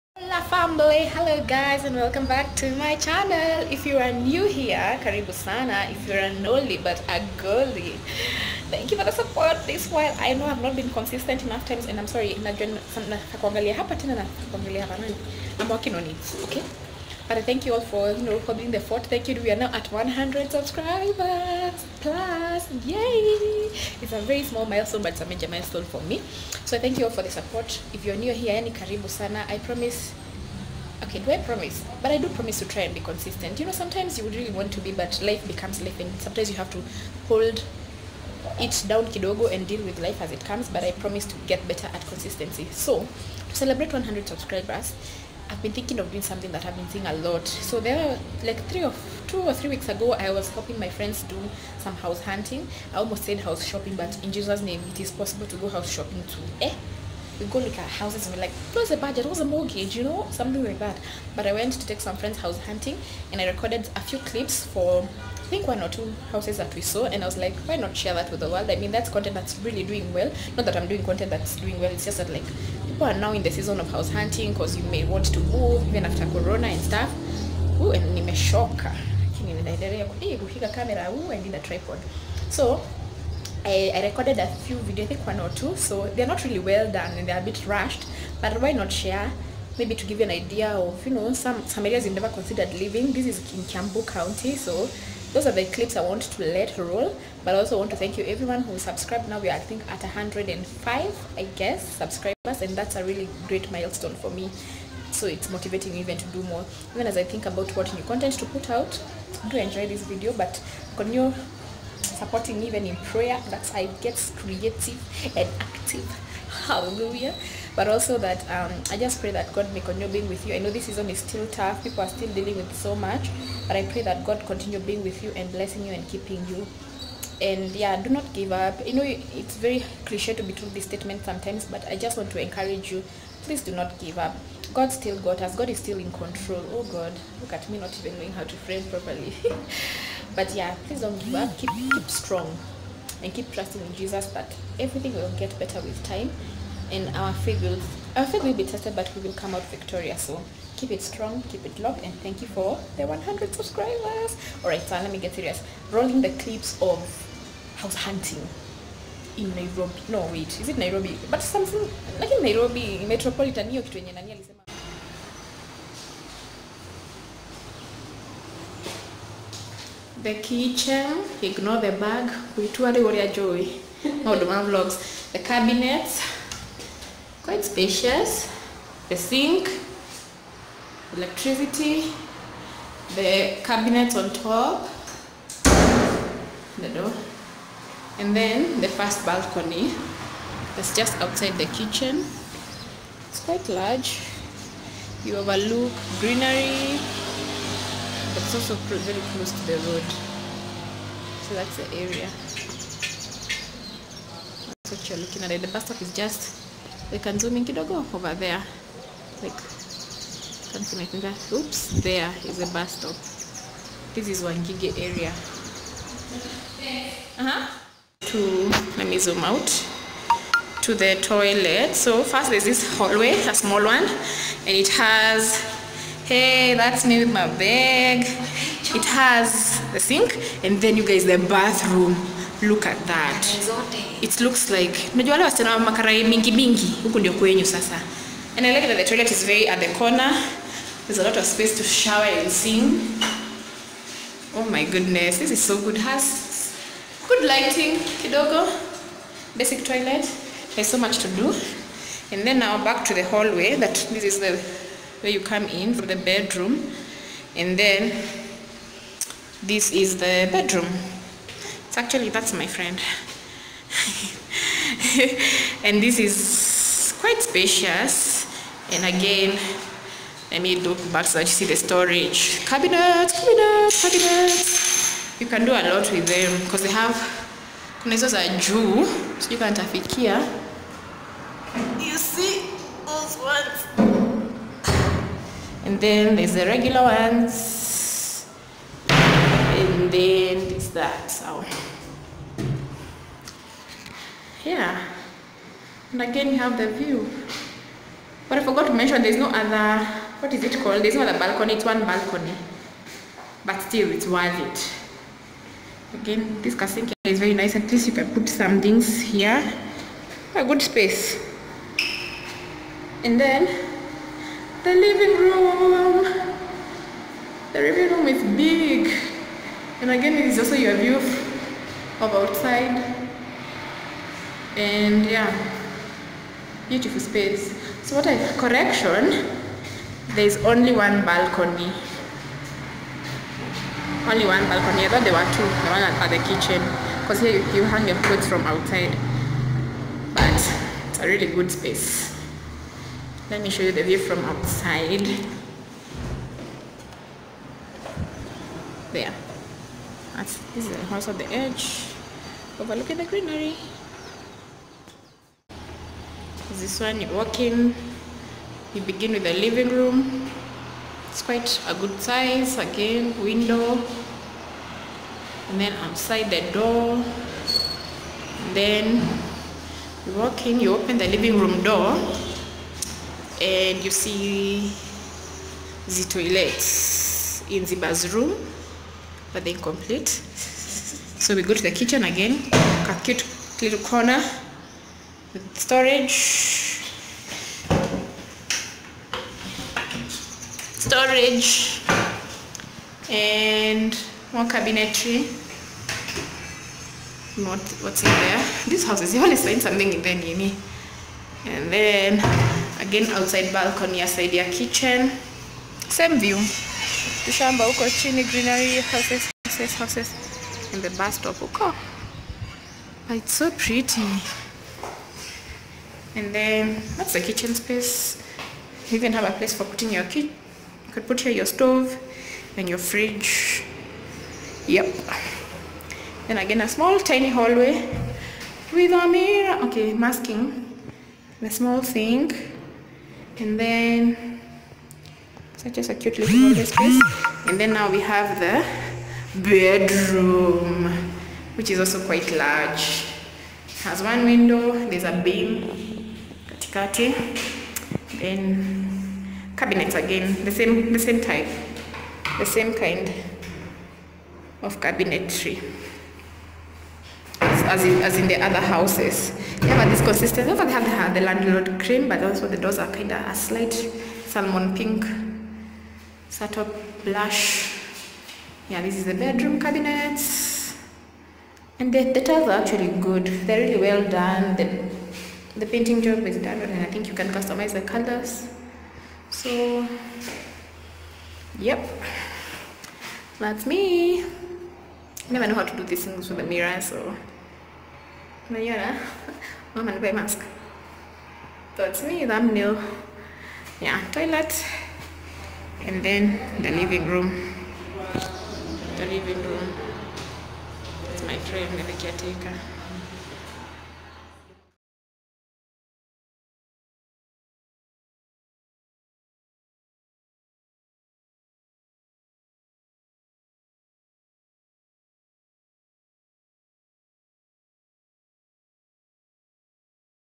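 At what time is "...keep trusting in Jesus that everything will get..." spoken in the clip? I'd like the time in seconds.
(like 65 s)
143 s.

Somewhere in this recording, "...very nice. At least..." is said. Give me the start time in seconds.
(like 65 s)
307 s.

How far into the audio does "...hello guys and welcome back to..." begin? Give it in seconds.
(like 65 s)
1 s.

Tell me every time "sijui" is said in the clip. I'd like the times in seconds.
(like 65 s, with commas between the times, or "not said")
279 s.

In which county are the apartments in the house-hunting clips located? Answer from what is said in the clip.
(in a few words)
Kiambu County.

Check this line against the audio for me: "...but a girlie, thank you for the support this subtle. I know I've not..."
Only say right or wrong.
wrong.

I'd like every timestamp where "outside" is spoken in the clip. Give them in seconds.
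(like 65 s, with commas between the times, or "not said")
191 s, 322 s, 338 s, 344 s, 366 s, 403 s.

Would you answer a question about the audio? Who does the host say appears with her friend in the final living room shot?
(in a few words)
the caretaker.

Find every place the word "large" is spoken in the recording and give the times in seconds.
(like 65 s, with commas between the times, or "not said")
193 s, 442 s.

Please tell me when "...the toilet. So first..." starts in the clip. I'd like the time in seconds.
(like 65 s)
220 s.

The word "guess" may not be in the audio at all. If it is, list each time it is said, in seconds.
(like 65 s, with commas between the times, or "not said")
101 s.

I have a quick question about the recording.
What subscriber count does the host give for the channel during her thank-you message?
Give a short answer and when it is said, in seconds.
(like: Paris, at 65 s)
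105, at 100 s.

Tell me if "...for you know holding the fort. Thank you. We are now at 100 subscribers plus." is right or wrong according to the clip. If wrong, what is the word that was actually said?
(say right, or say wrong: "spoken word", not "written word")
right.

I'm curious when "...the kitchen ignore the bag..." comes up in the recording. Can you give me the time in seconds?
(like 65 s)
170 s.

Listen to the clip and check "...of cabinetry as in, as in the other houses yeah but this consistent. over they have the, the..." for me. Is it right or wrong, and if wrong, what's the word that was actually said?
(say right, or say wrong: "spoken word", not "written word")
right.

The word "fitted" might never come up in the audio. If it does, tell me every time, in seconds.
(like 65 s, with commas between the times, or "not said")
not said.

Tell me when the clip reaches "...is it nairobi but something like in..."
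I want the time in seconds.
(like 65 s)
160 s.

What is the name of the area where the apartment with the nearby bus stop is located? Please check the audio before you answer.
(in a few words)
Wangige.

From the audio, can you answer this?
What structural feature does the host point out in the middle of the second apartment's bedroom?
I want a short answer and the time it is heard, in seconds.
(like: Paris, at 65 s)
a beam, at 445 s.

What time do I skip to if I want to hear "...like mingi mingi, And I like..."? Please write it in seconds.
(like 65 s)
234 s.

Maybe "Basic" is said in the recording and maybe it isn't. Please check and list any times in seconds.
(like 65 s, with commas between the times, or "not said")
249 s.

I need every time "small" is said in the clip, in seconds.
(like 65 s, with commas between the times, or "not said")
24 s, 223 s, 426 s, 431 s.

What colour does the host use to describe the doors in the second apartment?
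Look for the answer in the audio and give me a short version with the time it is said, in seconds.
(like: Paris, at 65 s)
salmon pink, at 464 s.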